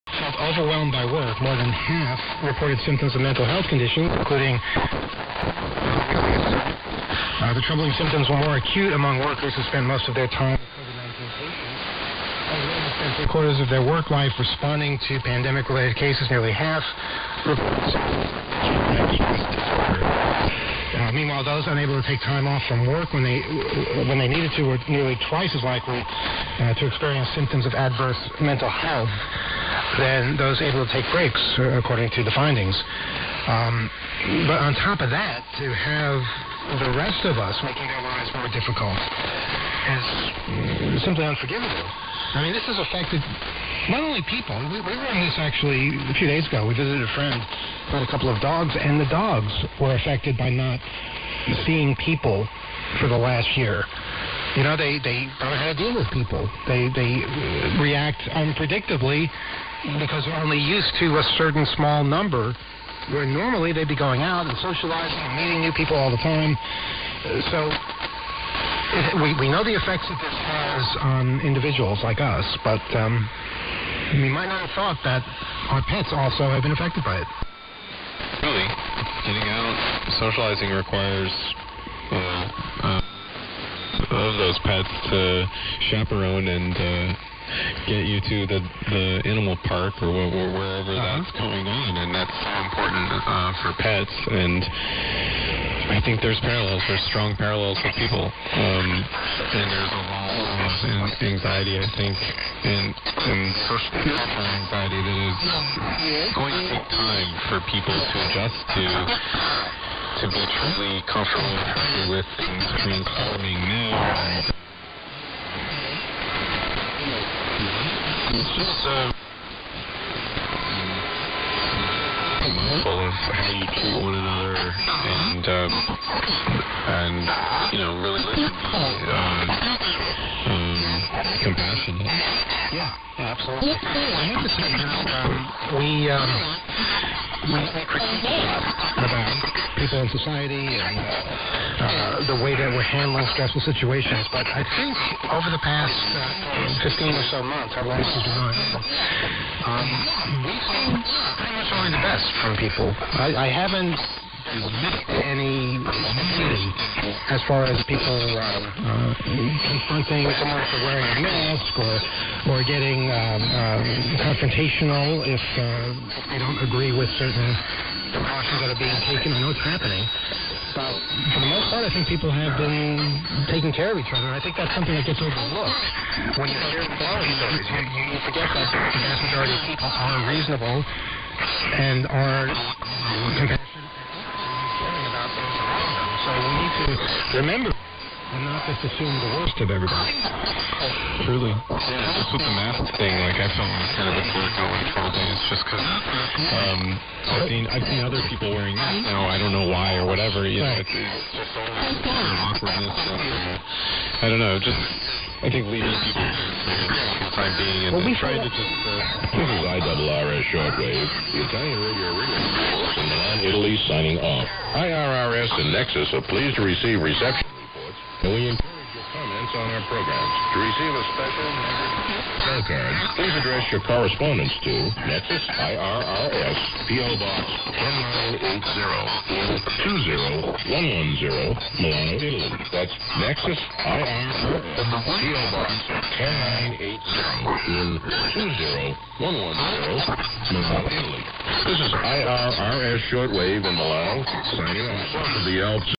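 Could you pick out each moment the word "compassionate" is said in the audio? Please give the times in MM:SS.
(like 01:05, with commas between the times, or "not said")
02:11, 03:02.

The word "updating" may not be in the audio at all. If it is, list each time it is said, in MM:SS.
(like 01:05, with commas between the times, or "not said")
not said.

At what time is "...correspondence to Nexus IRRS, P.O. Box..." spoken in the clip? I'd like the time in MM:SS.
03:43.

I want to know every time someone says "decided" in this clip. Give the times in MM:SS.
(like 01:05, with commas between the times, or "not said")
not said.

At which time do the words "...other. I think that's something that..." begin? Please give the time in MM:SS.
02:54.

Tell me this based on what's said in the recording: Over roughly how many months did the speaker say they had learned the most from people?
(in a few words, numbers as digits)
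15.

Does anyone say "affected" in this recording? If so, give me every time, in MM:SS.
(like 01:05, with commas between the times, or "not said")
00:42, 00:49, 01:16.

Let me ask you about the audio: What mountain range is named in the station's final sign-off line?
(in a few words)
the Alps.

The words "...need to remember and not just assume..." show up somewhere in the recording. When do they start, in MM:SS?
03:06.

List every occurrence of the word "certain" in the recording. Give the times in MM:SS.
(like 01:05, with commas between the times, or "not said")
01:01, 02:47.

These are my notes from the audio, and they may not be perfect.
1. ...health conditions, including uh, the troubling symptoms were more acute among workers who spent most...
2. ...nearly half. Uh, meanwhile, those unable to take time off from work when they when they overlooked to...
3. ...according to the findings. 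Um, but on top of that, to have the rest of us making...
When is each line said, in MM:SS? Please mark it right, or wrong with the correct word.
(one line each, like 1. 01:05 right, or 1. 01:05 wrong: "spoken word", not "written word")
1. 00:03 right
2. 00:16 wrong: "needed", not "overlooked"
3. 00:31 right.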